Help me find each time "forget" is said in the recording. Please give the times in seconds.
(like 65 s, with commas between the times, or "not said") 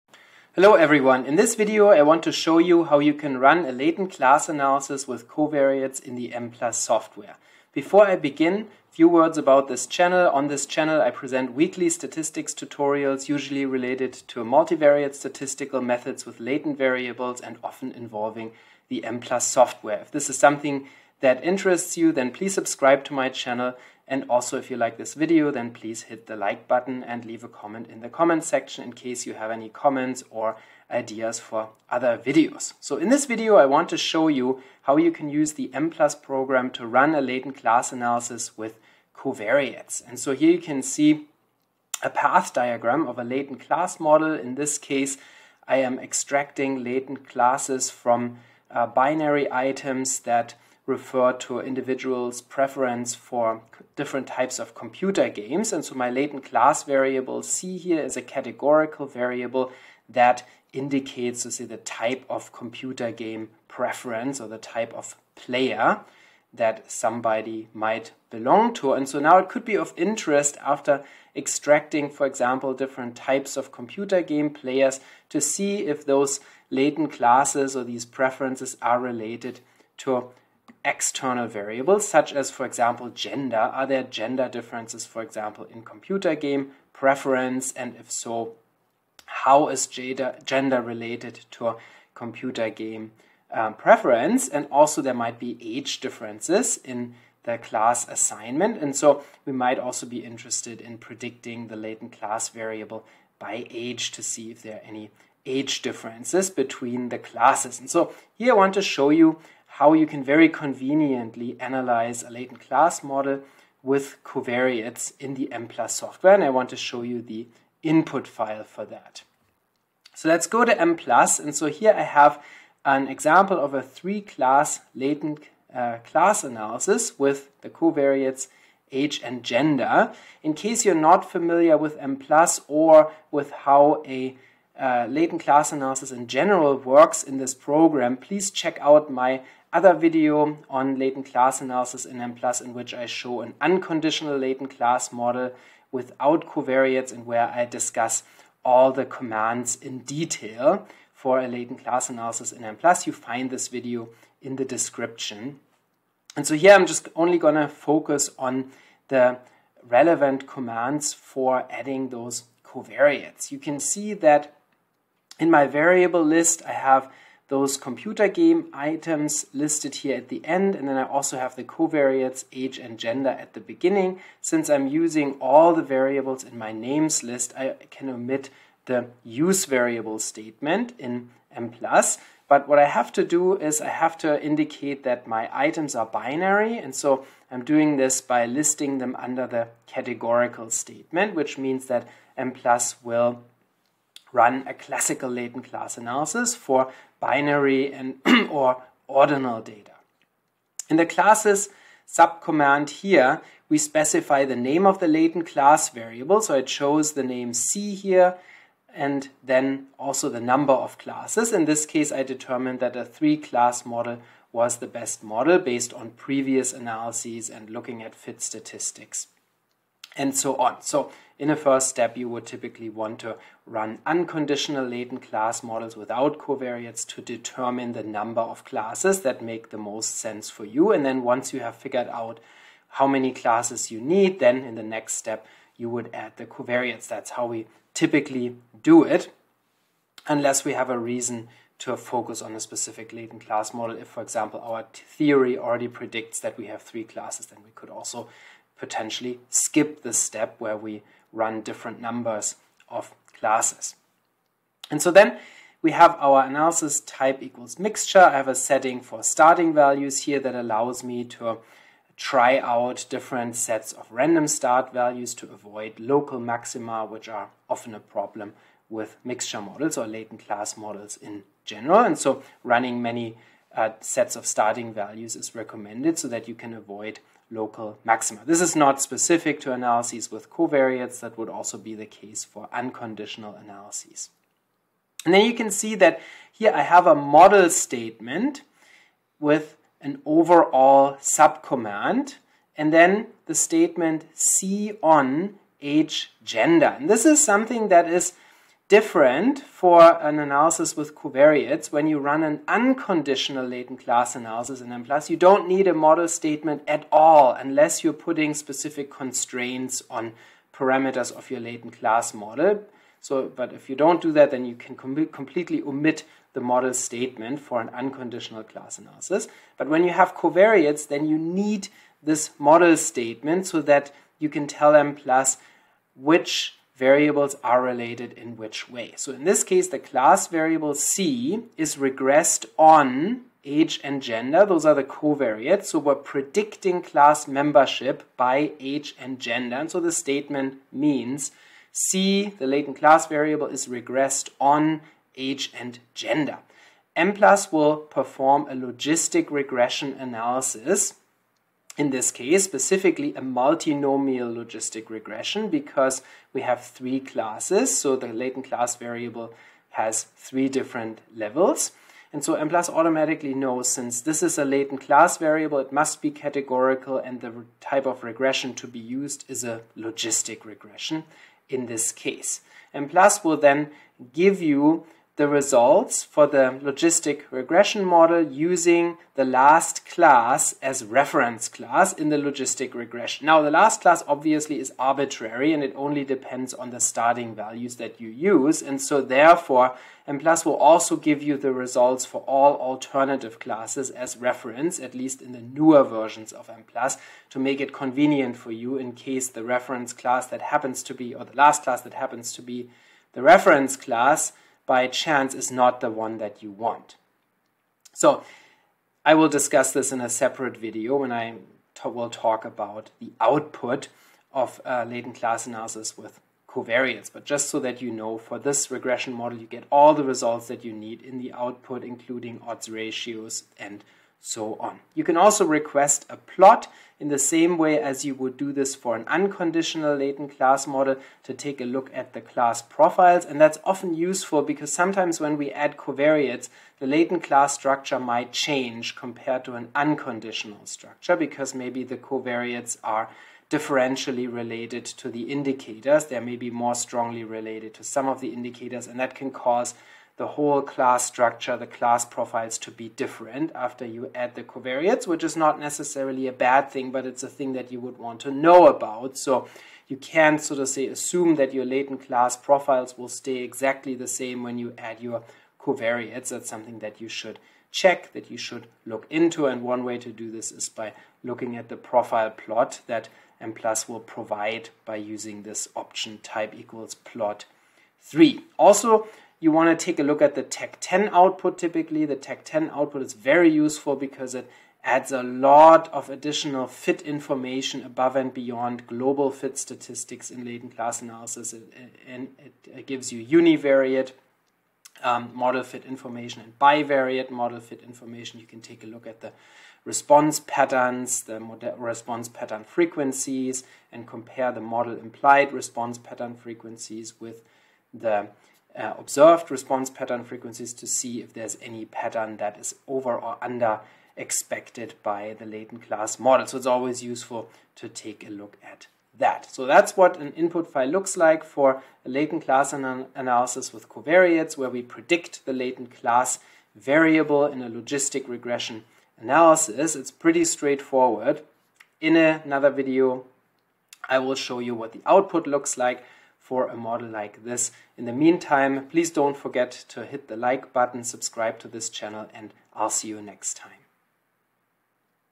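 539 s.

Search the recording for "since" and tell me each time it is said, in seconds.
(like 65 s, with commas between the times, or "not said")
174 s, 363 s.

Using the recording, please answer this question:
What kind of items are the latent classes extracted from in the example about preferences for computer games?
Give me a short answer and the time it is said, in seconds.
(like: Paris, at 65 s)
Binary items, at 48 s.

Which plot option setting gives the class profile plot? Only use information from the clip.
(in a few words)
Type equals plot 3.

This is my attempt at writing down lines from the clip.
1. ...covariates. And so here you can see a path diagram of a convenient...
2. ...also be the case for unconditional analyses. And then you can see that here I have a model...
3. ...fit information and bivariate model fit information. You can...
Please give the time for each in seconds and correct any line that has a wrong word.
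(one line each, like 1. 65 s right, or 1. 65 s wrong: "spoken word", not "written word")
1. 39 s wrong: "latent", not "convenient"
2. 281 s right
3. 495 s right.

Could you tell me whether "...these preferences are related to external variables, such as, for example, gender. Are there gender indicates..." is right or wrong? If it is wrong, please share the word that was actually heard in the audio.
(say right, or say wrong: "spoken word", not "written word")
wrong: "differences", not "indicates".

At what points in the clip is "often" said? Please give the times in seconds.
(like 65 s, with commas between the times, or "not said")
17 s, 267 s, 433 s.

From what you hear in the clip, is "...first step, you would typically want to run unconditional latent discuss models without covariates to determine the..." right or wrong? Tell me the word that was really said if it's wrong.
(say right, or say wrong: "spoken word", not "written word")
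wrong: "class", not "discuss".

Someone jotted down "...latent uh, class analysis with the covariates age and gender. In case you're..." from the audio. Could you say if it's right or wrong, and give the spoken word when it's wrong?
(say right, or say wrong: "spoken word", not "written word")
right.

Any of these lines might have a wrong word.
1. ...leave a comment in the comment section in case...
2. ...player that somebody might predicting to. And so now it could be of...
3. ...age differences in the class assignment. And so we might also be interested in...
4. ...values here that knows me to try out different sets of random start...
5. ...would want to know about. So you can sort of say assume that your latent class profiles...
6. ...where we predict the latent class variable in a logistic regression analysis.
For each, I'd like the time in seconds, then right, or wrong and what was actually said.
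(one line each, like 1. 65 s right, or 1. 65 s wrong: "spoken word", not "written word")
1. 27 s right
2. 65 s wrong: "belong", not "predicting"
3. 95 s right
4. 259 s wrong: "allows", not "knows"
5. 457 s right
6. 524 s right.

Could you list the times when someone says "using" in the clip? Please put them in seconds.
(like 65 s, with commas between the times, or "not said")
174 s, 378 s, 475 s.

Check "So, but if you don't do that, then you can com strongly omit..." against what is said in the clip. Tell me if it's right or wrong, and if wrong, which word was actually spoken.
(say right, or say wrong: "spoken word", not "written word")
wrong: "completely", not "strongly".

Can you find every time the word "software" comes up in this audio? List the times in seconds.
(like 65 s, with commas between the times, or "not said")
6 s, 19 s, 115 s.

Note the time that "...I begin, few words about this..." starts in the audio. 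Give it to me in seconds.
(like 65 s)
8 s.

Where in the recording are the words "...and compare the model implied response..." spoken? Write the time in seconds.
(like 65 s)
504 s.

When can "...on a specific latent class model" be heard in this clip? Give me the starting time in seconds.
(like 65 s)
242 s.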